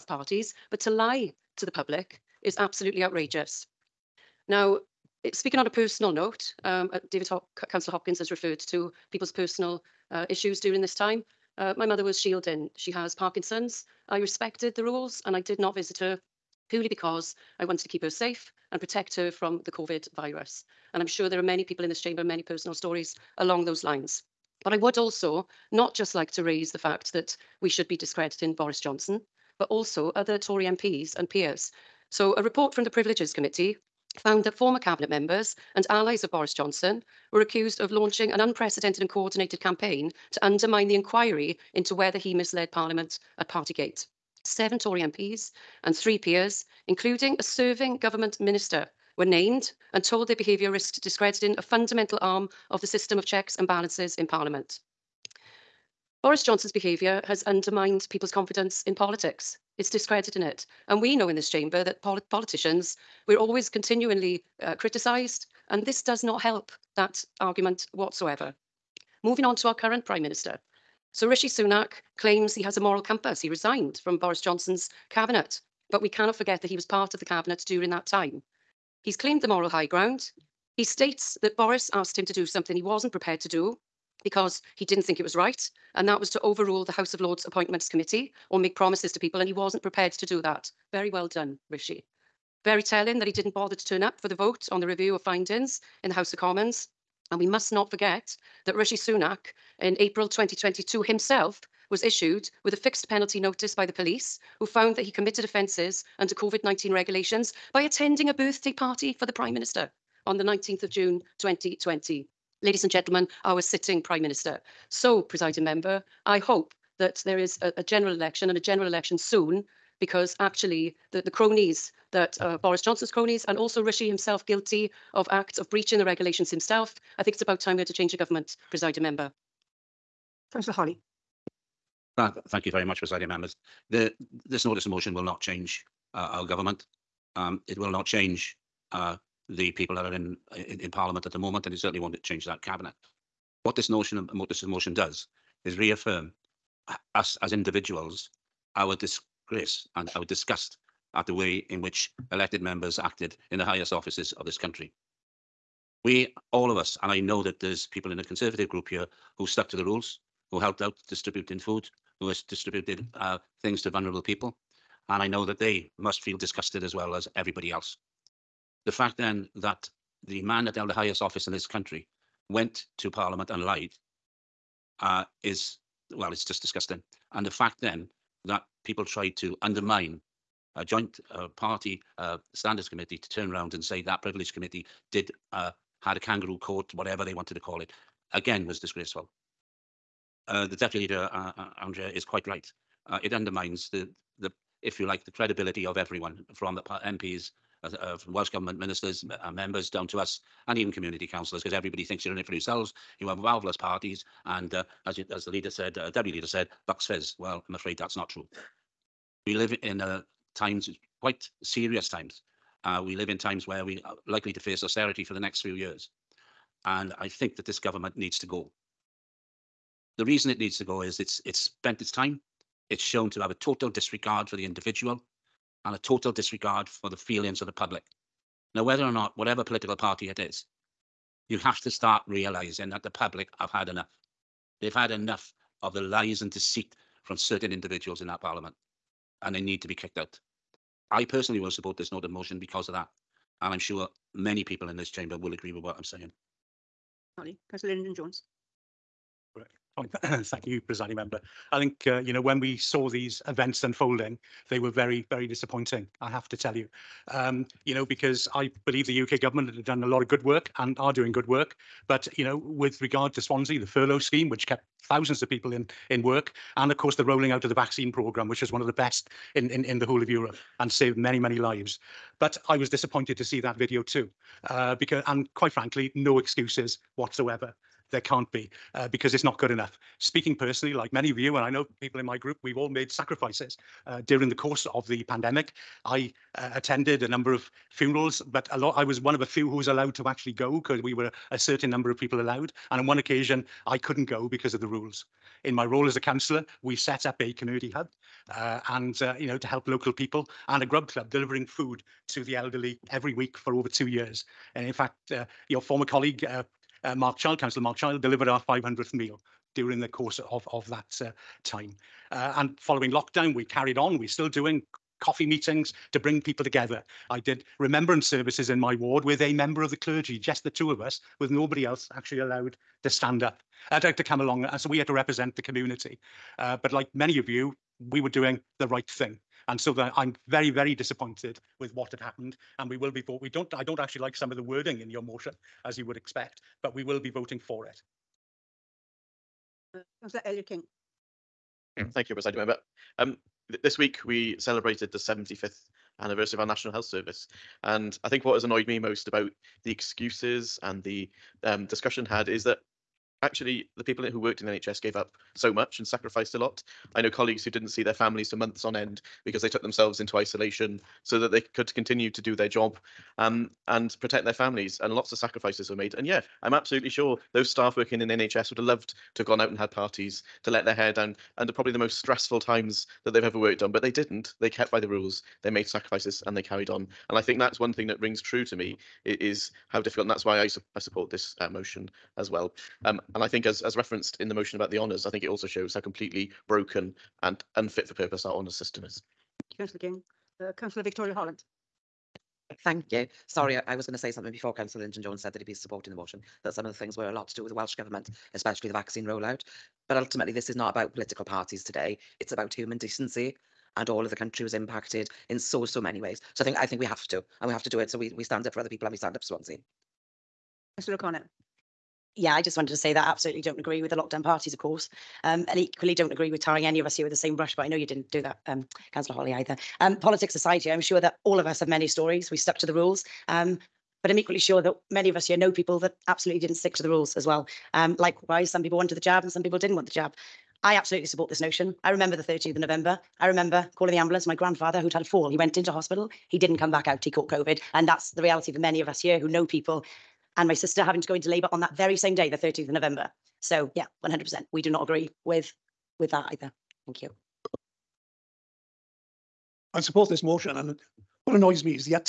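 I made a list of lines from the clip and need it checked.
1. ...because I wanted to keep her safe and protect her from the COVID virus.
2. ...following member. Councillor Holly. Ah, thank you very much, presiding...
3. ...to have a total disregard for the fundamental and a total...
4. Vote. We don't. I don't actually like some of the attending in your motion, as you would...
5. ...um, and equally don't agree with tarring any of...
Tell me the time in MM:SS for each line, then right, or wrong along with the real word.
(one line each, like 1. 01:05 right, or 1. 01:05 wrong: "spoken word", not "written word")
1. 00:16 right
2. 02:08 wrong: "presiding", not "following"
3. 03:43 wrong: "individual", not "fundamental"
4. 05:33 wrong: "wording", not "attending"
5. 06:55 right.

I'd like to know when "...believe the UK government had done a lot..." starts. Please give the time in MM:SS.
04:18.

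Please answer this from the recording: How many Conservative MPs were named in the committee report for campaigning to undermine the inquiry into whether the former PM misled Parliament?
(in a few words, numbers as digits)
7.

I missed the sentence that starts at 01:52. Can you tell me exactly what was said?
Ladies and gentlemen, our sitting Prime Minister.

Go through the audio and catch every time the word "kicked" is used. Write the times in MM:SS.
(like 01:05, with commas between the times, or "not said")
03:59.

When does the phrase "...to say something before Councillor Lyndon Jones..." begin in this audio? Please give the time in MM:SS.
06:34.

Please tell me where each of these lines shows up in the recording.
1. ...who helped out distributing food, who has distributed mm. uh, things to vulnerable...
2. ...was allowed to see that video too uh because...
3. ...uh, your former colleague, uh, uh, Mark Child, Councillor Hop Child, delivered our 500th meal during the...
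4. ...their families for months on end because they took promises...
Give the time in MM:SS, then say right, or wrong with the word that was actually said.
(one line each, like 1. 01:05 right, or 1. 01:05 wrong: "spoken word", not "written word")
1. 02:40 right
2. 04:32 wrong: "disappointed", not "allowed"
3. 05:05 wrong: "Mark", not "Hop"
4. 05:58 wrong: "themselves", not "promises".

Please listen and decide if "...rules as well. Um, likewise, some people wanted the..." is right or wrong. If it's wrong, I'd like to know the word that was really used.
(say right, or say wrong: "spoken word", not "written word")
right.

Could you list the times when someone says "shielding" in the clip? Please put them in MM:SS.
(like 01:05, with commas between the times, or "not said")
00:12.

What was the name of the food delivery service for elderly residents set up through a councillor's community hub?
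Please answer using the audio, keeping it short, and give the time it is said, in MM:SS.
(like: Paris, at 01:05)
grub club, at 05:00.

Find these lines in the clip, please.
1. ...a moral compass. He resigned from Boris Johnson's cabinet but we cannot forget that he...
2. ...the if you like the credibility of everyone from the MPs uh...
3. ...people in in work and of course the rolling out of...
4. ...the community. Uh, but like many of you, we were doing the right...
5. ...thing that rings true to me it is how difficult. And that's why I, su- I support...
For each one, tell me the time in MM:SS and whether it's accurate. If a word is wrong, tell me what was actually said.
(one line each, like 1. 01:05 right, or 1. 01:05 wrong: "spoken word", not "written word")
1. 01:12 right
2. 03:14 right
3. 04:25 right
4. 05:25 right
5. 06:17 right.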